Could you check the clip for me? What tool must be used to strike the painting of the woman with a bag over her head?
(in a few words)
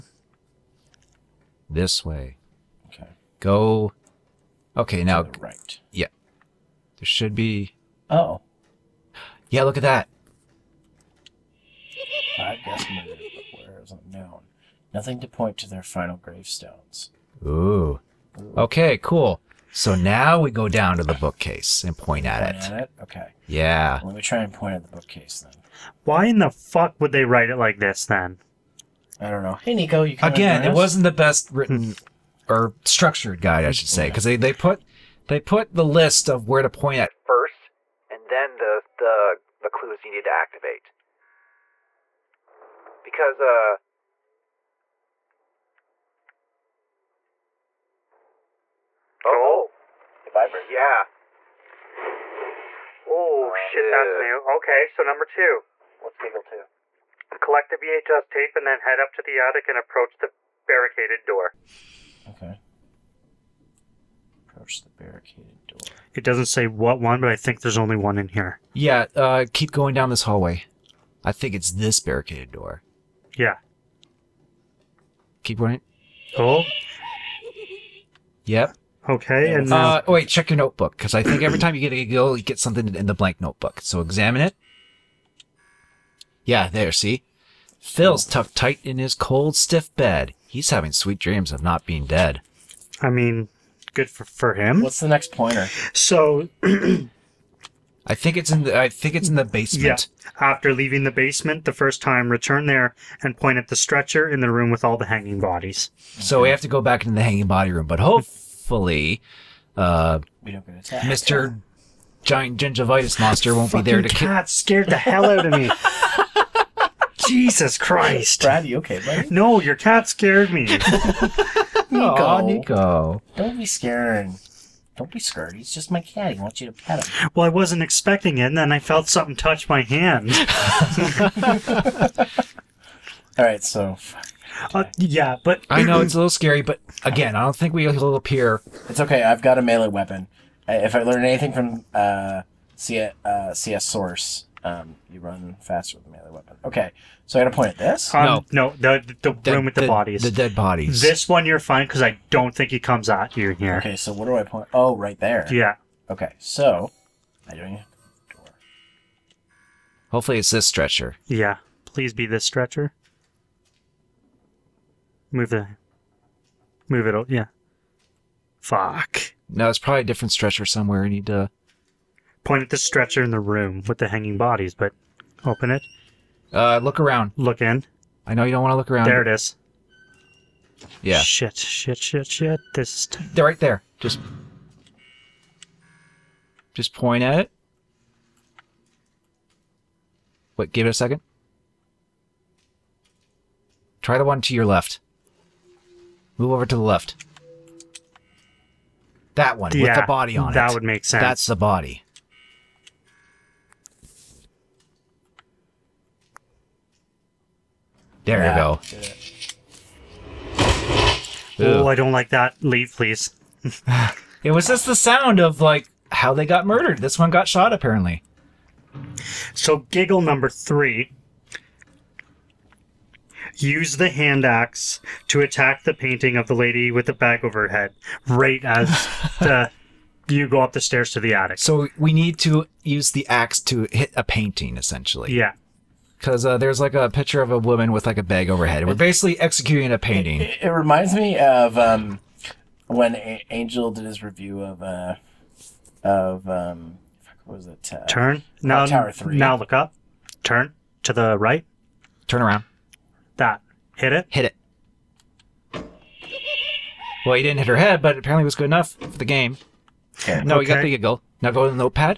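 hand axe.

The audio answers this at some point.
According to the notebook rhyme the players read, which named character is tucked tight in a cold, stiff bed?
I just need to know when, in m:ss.
1:27.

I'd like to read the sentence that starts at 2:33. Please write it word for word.
Okay, so what do I point?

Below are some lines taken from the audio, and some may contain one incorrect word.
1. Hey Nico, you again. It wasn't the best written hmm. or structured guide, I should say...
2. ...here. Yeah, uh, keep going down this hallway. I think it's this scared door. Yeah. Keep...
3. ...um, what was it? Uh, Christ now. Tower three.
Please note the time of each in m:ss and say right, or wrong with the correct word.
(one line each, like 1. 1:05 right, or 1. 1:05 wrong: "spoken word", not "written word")
1. 0:29 right
2. 1:08 wrong: "barricaded", not "scared"
3. 4:06 wrong: "Turn", not "Christ".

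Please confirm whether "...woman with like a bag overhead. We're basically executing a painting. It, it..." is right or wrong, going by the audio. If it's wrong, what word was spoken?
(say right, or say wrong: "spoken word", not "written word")
right.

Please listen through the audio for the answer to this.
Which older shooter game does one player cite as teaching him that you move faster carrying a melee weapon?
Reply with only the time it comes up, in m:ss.
2:23.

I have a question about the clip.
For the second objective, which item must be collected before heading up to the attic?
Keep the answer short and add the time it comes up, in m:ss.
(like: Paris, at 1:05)
VHS tape, at 0:57.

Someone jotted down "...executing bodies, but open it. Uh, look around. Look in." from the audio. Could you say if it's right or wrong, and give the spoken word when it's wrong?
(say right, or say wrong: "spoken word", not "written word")
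wrong: "hanging", not "executing".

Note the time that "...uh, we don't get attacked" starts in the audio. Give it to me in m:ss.
1:49.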